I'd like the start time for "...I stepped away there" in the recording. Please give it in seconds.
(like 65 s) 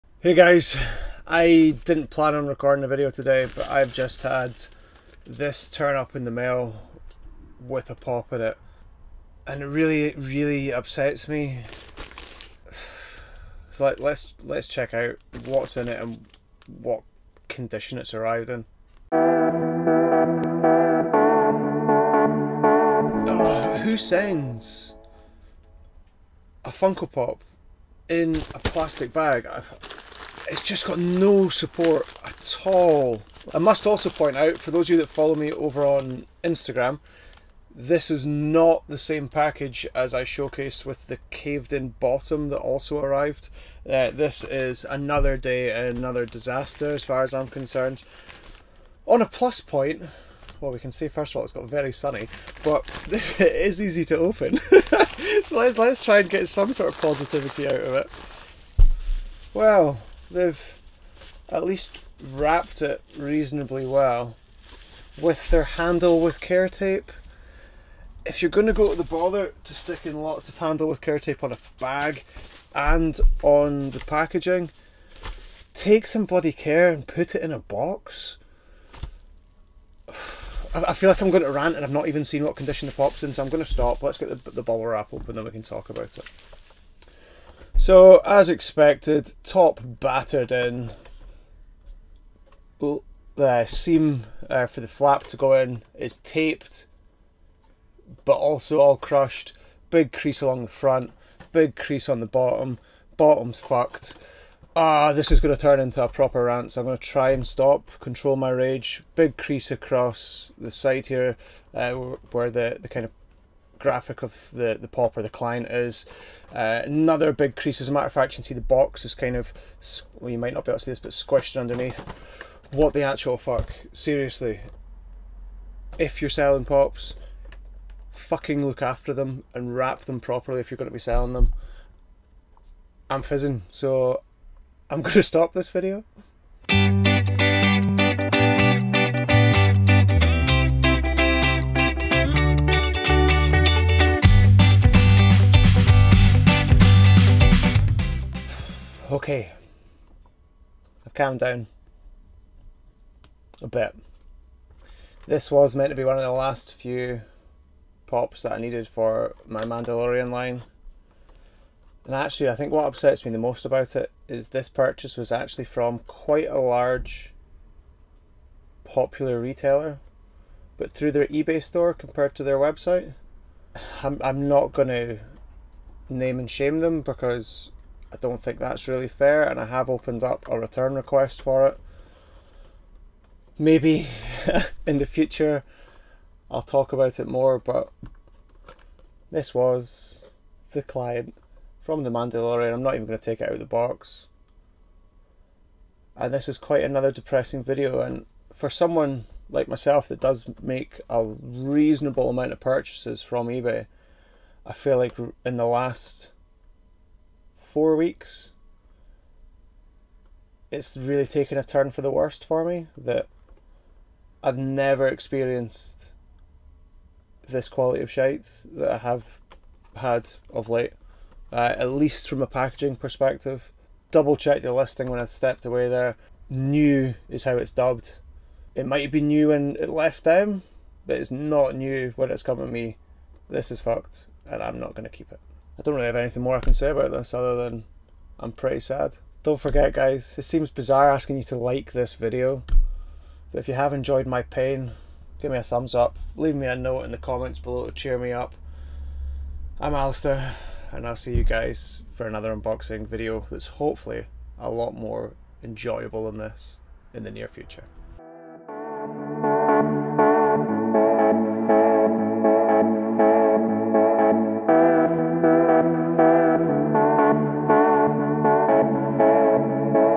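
225 s.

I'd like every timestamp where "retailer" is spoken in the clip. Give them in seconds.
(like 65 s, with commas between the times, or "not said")
169 s.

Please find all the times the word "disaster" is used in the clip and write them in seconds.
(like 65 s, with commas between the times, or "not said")
46 s.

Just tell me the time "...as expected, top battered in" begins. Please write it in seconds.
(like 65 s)
88 s.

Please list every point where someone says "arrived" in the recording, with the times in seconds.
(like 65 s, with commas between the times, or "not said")
18 s, 42 s.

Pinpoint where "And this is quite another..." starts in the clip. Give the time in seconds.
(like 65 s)
196 s.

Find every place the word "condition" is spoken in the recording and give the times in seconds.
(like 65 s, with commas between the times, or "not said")
17 s, 82 s.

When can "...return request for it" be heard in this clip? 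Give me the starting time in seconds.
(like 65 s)
180 s.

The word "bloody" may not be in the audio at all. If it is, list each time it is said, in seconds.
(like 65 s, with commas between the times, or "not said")
76 s.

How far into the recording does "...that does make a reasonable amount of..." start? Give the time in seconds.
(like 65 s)
200 s.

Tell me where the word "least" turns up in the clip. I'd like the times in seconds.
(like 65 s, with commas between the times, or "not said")
61 s, 221 s.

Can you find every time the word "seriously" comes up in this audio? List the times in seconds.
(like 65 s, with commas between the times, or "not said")
123 s.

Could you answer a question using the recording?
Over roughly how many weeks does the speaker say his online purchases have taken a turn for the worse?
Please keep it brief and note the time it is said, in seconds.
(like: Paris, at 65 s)
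4, at 207 s.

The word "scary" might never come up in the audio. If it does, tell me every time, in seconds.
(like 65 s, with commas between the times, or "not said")
not said.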